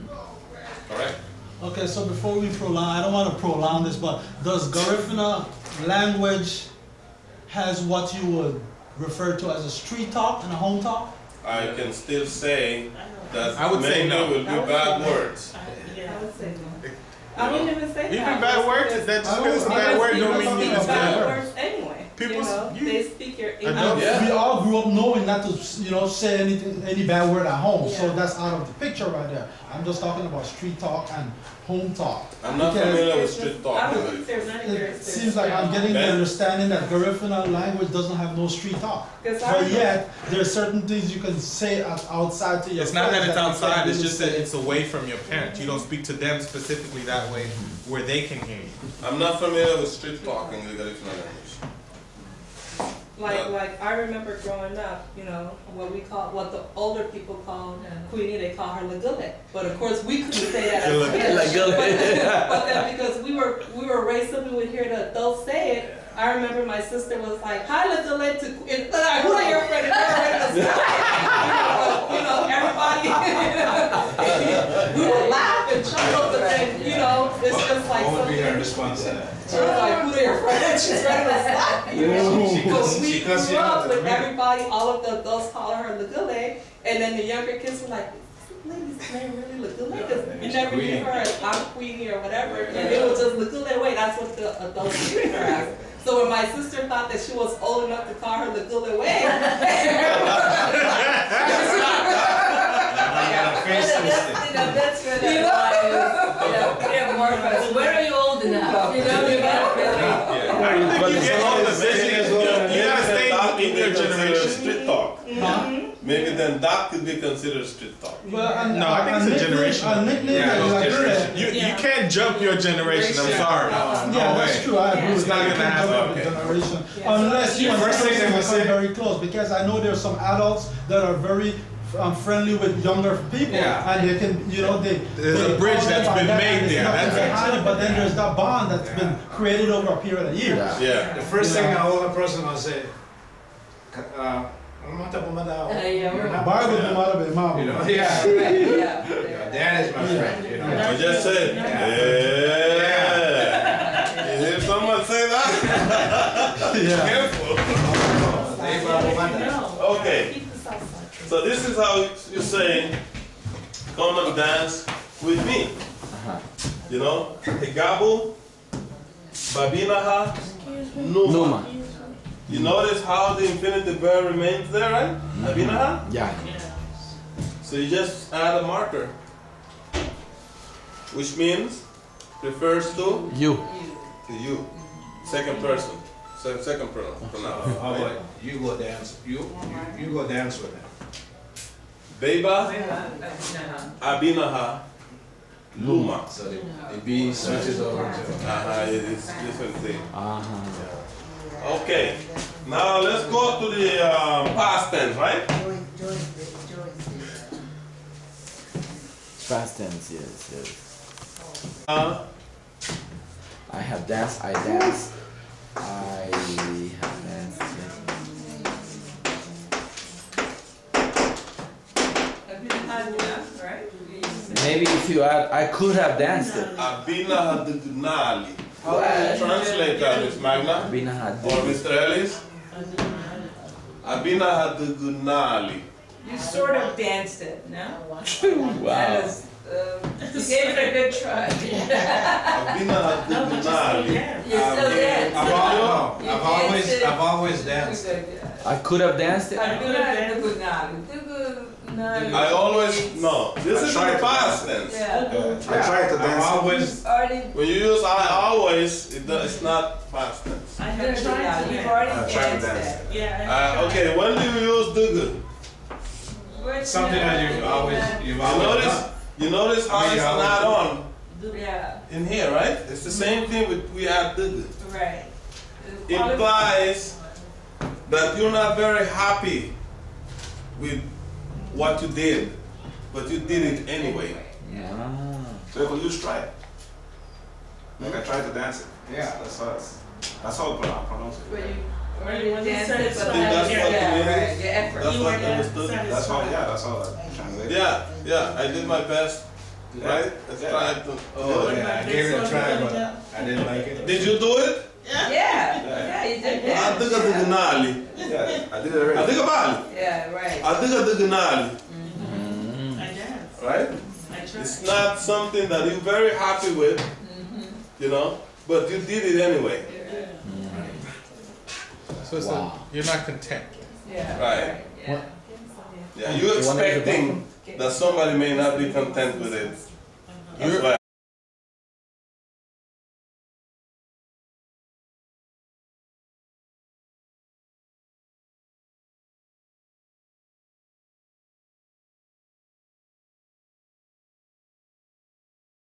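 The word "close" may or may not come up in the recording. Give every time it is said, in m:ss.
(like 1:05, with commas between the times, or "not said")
2:08.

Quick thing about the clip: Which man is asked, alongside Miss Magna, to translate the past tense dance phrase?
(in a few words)
Mr. Ellis.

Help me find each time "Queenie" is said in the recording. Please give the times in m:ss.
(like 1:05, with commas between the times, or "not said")
0:58, 1:08, 1:31.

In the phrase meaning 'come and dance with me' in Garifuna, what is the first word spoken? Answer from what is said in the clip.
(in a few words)
Higabu.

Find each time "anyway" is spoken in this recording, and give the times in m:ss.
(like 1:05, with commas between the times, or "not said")
4:43, 5:19.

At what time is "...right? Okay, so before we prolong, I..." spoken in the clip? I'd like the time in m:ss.
0:00.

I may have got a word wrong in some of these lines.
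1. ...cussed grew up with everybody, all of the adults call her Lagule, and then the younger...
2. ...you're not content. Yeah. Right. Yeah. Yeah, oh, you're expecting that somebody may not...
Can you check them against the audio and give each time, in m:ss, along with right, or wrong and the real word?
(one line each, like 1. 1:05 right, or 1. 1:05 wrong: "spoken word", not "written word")
1. 1:23 right
2. 5:22 right.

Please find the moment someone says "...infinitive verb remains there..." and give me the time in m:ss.
2:53.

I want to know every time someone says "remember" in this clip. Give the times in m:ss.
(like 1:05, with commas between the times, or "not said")
0:53, 1:06.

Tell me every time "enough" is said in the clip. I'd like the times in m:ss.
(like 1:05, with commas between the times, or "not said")
1:37, 1:48.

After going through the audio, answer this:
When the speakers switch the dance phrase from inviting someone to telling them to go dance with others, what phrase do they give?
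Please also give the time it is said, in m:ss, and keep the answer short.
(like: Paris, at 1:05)
Beba, Abinaha, Luma, at 3:12.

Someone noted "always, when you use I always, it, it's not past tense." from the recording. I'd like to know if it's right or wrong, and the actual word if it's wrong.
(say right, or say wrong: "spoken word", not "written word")
right.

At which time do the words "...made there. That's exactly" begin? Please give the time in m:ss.
2:16.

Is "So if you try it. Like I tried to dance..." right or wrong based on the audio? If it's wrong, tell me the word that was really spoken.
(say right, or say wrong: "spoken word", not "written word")
right.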